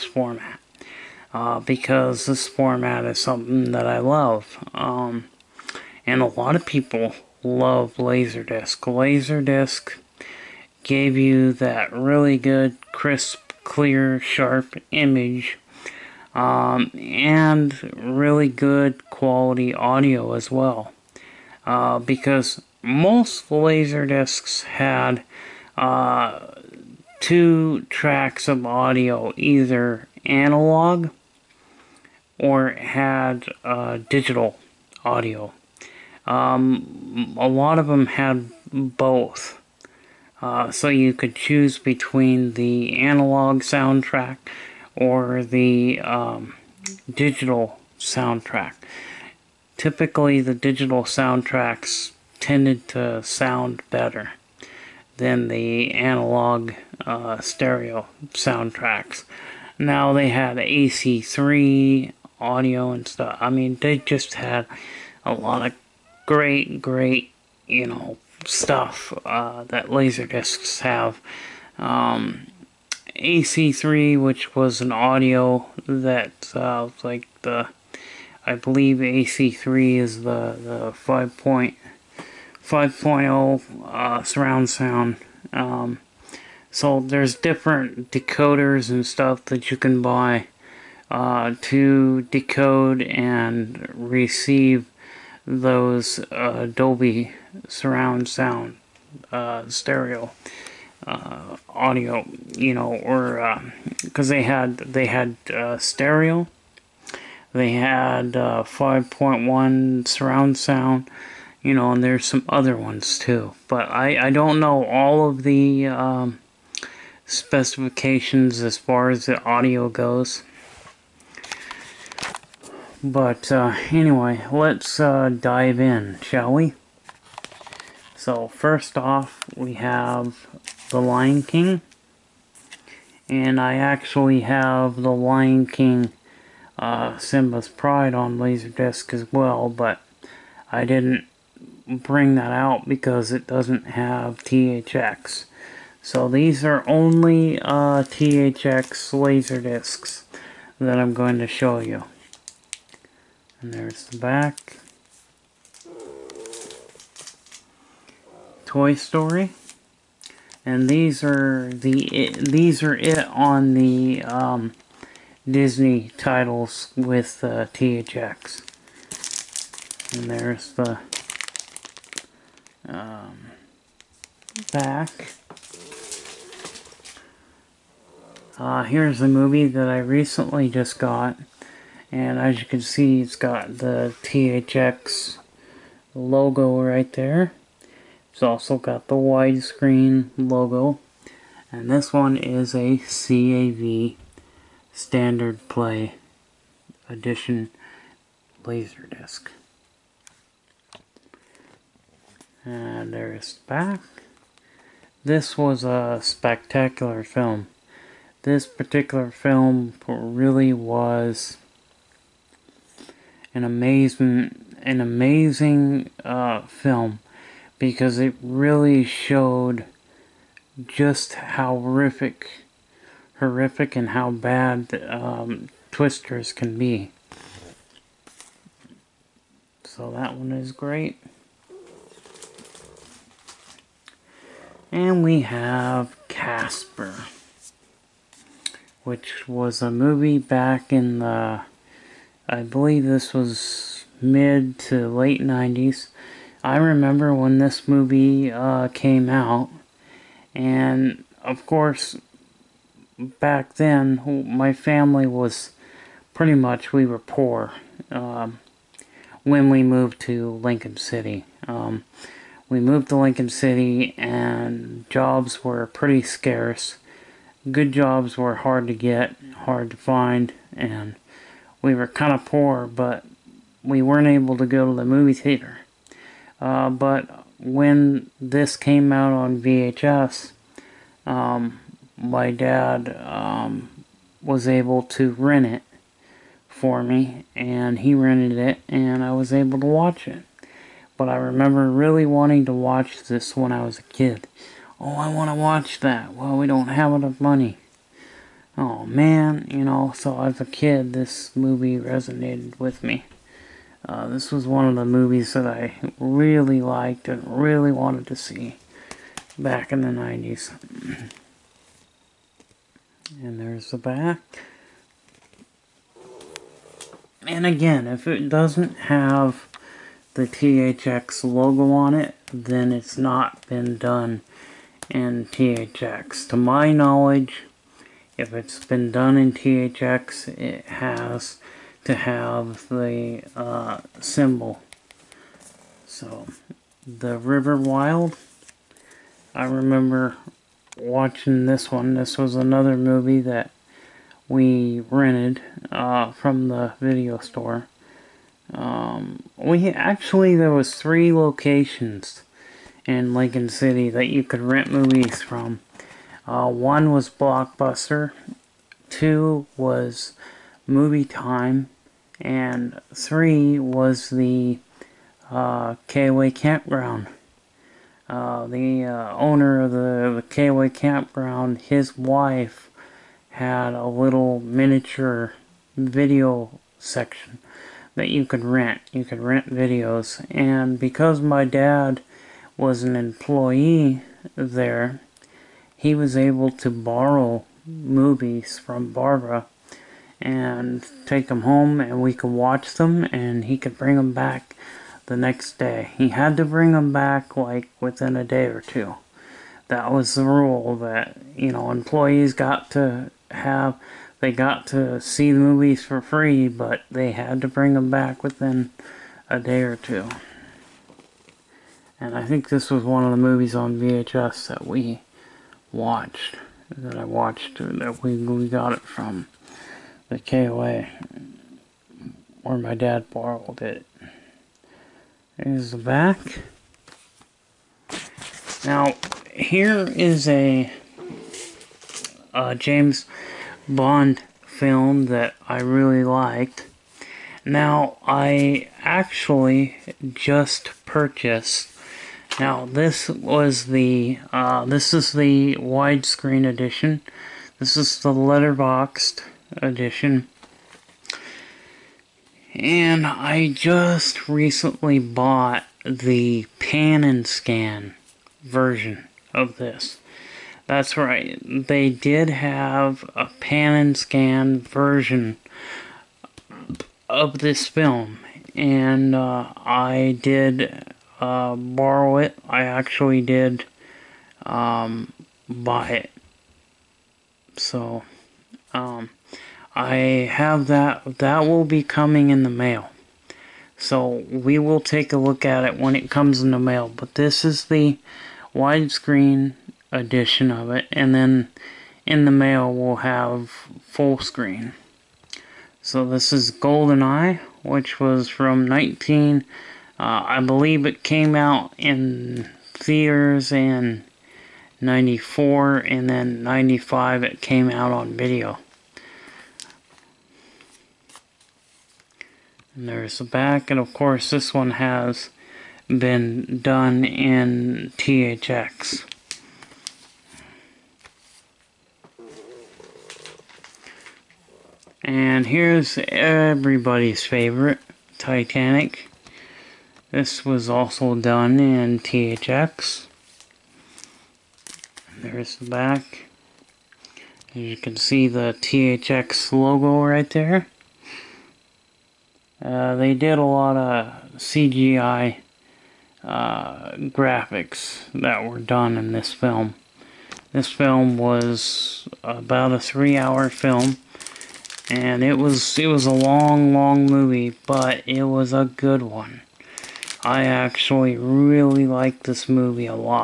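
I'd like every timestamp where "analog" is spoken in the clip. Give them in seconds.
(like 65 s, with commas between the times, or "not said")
30 s, 42 s, 55 s.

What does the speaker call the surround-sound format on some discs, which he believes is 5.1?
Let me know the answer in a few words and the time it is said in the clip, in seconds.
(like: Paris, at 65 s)
AC3, at 73 s.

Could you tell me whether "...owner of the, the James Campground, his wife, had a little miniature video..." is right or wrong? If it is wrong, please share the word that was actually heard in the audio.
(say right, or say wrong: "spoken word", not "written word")
wrong: "KOA", not "James".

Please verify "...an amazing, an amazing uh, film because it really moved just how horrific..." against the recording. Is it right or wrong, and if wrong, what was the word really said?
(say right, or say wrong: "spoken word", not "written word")
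wrong: "showed", not "moved".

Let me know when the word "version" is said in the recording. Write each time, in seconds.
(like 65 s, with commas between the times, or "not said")
458 s, 464 s.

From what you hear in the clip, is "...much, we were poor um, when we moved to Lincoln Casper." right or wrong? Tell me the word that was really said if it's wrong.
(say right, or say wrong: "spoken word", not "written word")
wrong: "City", not "Casper".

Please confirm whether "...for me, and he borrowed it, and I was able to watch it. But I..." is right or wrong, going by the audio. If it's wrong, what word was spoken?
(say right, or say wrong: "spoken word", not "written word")
wrong: "rented", not "borrowed".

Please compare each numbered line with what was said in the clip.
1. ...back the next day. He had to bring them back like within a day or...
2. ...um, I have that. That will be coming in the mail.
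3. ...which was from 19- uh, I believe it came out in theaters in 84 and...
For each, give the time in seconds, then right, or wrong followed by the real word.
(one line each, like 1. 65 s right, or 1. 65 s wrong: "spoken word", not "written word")
1. 394 s right
2. 478 s right
3. 497 s wrong: "94", not "84".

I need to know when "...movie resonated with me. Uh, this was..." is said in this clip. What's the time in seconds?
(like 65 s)
301 s.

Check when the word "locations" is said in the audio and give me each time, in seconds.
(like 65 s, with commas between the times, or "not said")
351 s.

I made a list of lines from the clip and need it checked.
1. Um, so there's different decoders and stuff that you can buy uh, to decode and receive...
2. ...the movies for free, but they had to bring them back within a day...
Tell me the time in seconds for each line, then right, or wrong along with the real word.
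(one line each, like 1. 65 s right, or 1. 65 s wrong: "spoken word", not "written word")
1. 85 s right
2. 405 s right.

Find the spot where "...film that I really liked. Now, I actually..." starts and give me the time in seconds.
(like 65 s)
434 s.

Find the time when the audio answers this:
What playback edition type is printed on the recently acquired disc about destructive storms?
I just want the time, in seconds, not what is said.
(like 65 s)
192 s.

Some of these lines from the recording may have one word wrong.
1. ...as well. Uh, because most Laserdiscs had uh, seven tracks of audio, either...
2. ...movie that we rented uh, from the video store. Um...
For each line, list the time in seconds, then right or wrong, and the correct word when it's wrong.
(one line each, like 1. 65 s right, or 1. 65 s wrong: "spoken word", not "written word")
1. 20 s wrong: "two", not "seven"
2. 342 s right.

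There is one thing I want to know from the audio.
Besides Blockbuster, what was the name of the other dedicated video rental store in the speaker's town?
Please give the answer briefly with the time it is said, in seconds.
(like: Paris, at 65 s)
Movie Time, at 360 s.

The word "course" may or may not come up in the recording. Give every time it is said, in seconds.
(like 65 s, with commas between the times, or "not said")
251 s, 514 s.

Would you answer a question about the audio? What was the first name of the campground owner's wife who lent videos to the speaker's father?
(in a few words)
Barbara.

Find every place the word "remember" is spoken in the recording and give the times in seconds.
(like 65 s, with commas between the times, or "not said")
246 s, 291 s, 339 s.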